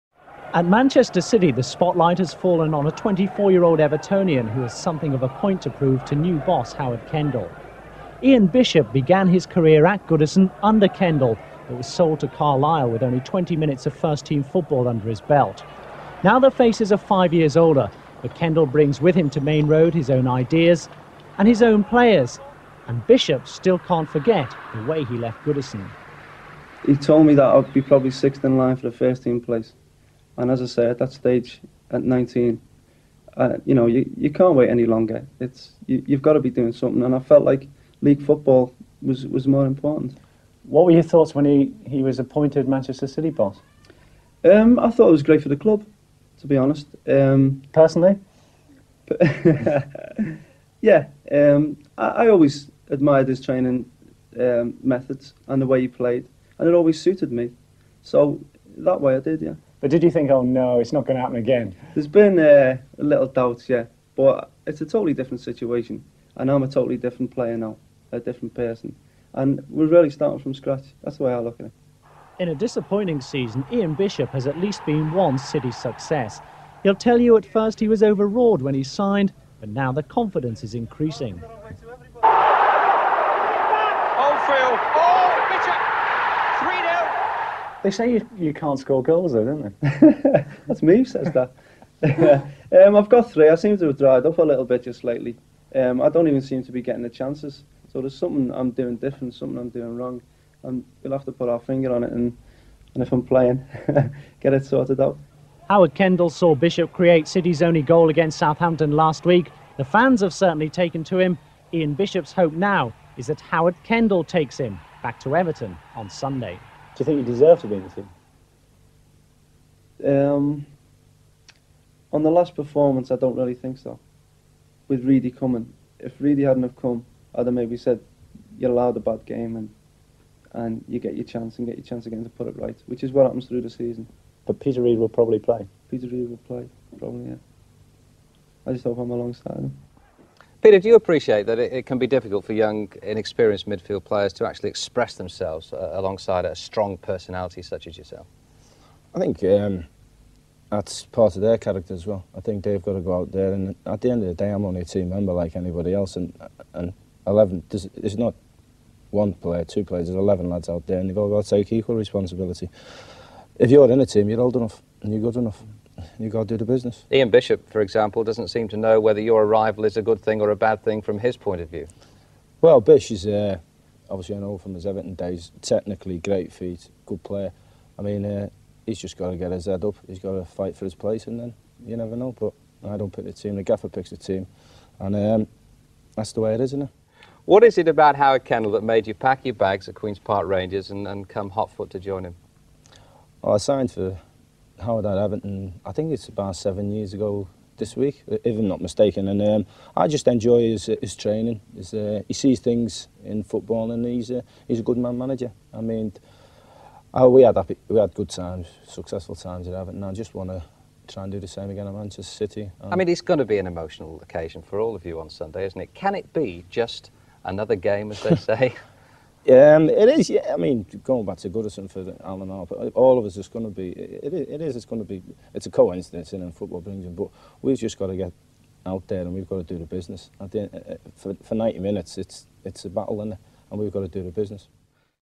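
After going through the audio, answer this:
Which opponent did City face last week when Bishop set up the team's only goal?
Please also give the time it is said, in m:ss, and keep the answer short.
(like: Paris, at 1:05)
Southampton, at 1:48.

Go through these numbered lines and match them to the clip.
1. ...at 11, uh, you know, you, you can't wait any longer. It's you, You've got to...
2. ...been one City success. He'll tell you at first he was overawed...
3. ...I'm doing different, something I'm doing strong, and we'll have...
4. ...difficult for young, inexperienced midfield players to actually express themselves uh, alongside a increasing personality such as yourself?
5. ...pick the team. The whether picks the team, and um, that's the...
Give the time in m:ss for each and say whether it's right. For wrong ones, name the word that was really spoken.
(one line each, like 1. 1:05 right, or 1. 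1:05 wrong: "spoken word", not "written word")
1. 0:31 wrong: "19", not "11"
2. 1:14 right
3. 1:38 wrong: "wrong", not "strong"
4. 2:22 wrong: "strong", not "increasing"
5. 3:03 wrong: "gaffer", not "whether".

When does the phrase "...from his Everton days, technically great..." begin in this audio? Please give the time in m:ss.
2:54.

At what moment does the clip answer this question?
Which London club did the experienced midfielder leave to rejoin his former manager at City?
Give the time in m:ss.
3:09.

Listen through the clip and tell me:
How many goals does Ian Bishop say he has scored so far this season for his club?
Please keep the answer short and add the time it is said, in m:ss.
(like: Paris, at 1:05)
3, at 1:33.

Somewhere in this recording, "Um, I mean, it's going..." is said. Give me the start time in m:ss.
3:32.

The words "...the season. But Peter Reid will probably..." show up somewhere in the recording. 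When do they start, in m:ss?
2:13.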